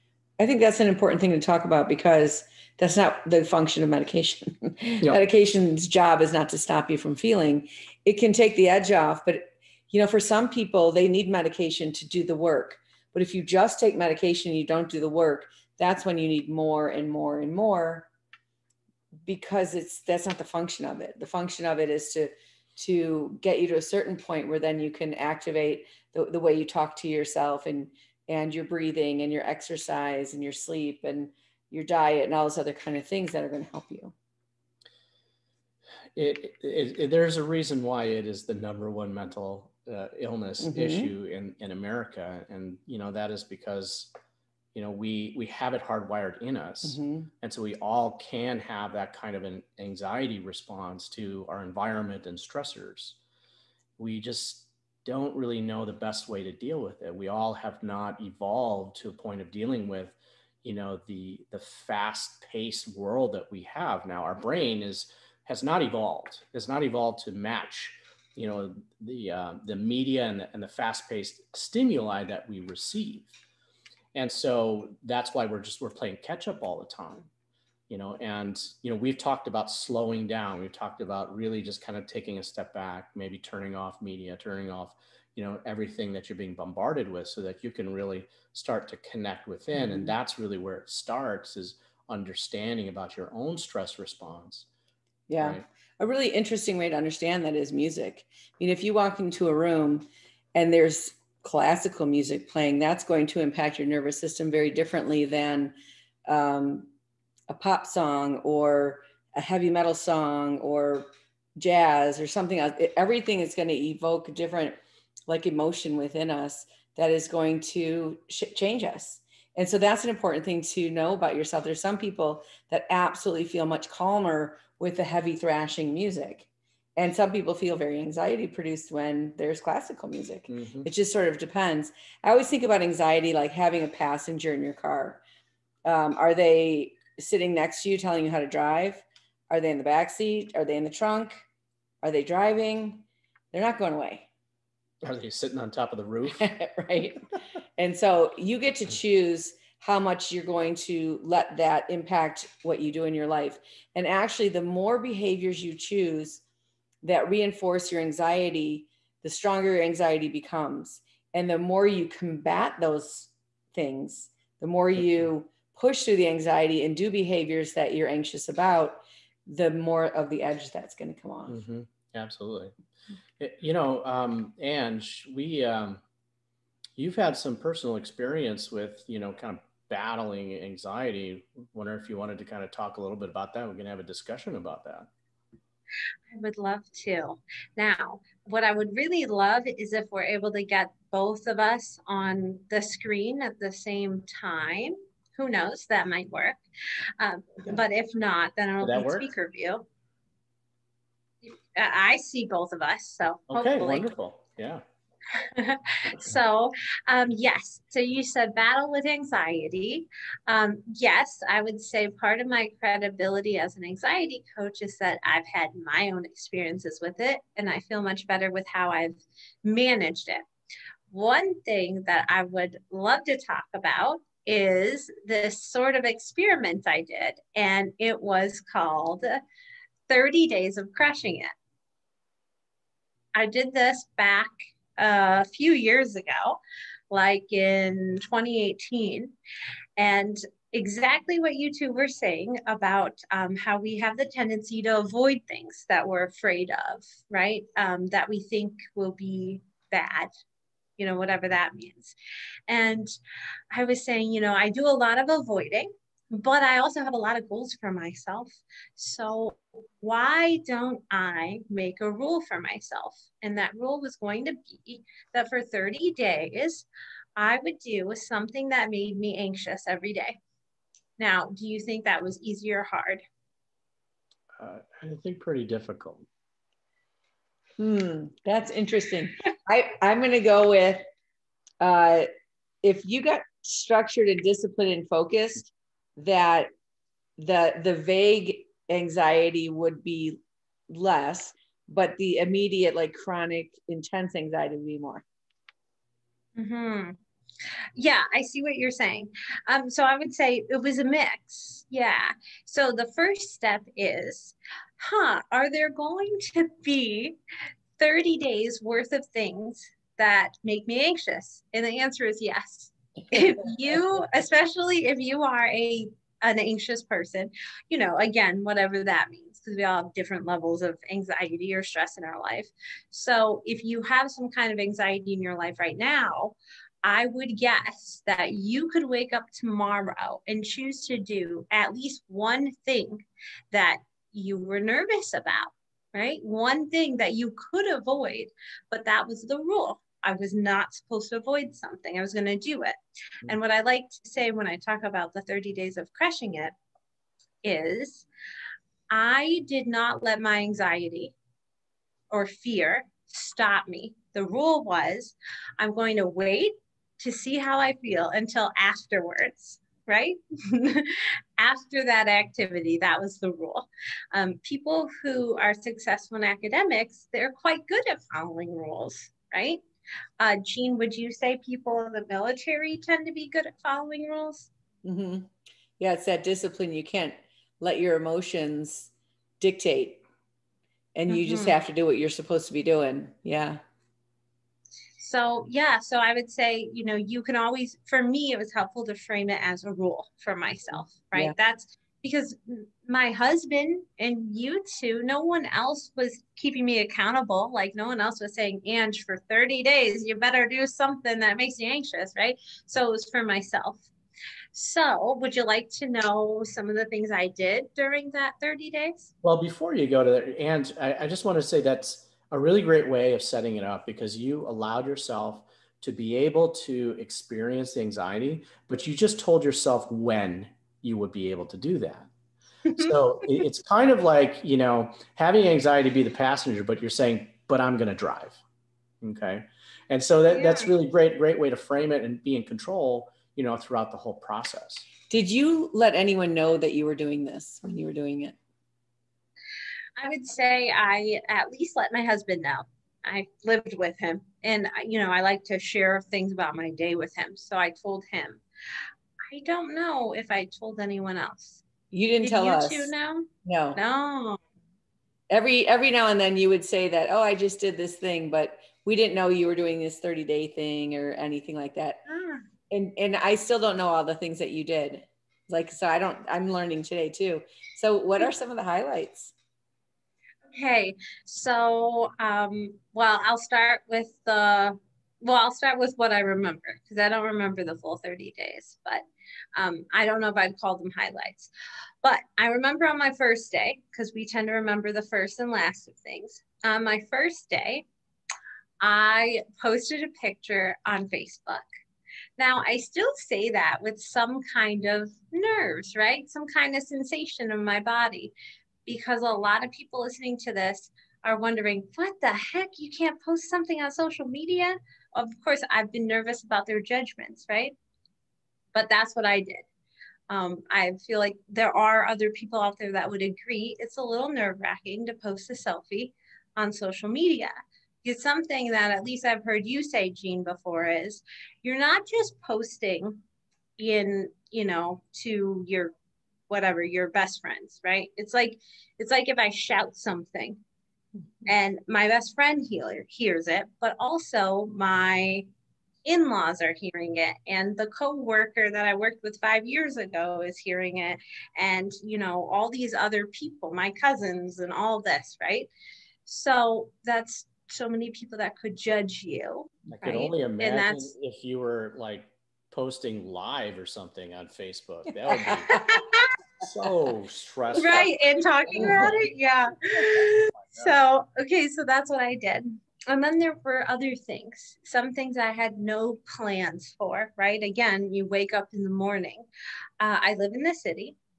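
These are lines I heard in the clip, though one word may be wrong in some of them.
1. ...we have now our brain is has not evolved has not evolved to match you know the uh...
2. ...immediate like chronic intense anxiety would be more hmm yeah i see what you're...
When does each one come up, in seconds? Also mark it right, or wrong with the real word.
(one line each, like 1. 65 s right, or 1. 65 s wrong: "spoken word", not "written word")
1. 63 s right
2. 292 s right.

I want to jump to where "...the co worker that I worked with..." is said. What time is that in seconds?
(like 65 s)
537 s.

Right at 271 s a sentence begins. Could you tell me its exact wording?
Now, do you think that was easy or hard?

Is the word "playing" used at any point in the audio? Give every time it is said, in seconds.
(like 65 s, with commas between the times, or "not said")
75 s, 102 s.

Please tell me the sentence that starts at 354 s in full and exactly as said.
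The rule was I'm going to wait to see how I feel until afterwards right?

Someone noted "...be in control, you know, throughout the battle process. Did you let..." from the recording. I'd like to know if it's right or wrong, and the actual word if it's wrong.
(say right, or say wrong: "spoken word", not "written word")
wrong: "whole", not "battle".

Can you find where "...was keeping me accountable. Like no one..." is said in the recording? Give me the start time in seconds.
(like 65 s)
396 s.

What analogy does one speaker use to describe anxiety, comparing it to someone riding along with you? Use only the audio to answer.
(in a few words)
A passenger in your car.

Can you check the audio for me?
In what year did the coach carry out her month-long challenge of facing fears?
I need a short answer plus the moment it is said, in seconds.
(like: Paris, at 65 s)
2018, at 238 s.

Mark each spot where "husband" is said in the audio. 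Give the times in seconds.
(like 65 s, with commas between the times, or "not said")
393 s, 442 s.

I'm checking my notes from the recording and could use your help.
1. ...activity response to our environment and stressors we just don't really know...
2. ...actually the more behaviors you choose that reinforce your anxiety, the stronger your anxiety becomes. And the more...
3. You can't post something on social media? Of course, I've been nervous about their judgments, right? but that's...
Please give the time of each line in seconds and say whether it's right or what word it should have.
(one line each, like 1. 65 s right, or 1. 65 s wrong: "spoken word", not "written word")
1. 49 s wrong: "anxiety", not "activity"
2. 154 s right
3. 502 s right.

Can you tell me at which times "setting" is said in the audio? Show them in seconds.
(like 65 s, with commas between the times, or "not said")
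413 s.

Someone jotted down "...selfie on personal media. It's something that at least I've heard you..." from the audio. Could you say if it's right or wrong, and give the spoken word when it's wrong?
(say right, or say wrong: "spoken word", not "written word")
wrong: "social", not "personal".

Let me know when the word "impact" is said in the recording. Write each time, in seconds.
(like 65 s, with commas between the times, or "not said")
103 s, 151 s.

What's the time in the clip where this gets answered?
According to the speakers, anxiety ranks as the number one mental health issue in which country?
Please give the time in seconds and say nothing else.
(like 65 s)
41 s.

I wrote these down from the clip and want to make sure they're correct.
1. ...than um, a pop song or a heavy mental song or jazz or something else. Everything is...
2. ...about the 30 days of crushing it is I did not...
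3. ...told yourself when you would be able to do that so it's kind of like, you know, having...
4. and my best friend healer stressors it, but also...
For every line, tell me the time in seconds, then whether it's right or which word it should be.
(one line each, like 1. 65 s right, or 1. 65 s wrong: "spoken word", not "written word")
1. 105 s wrong: "metal", not "mental"
2. 345 s right
3. 419 s right
4. 531 s wrong: "hears", not "stressors".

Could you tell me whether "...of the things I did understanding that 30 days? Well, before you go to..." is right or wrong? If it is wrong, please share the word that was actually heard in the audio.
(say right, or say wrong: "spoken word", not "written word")
wrong: "during", not "understanding".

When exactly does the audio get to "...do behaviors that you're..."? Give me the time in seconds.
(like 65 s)
166 s.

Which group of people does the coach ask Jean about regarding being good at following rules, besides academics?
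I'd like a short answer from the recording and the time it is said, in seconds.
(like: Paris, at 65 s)
People in the military, at 372 s.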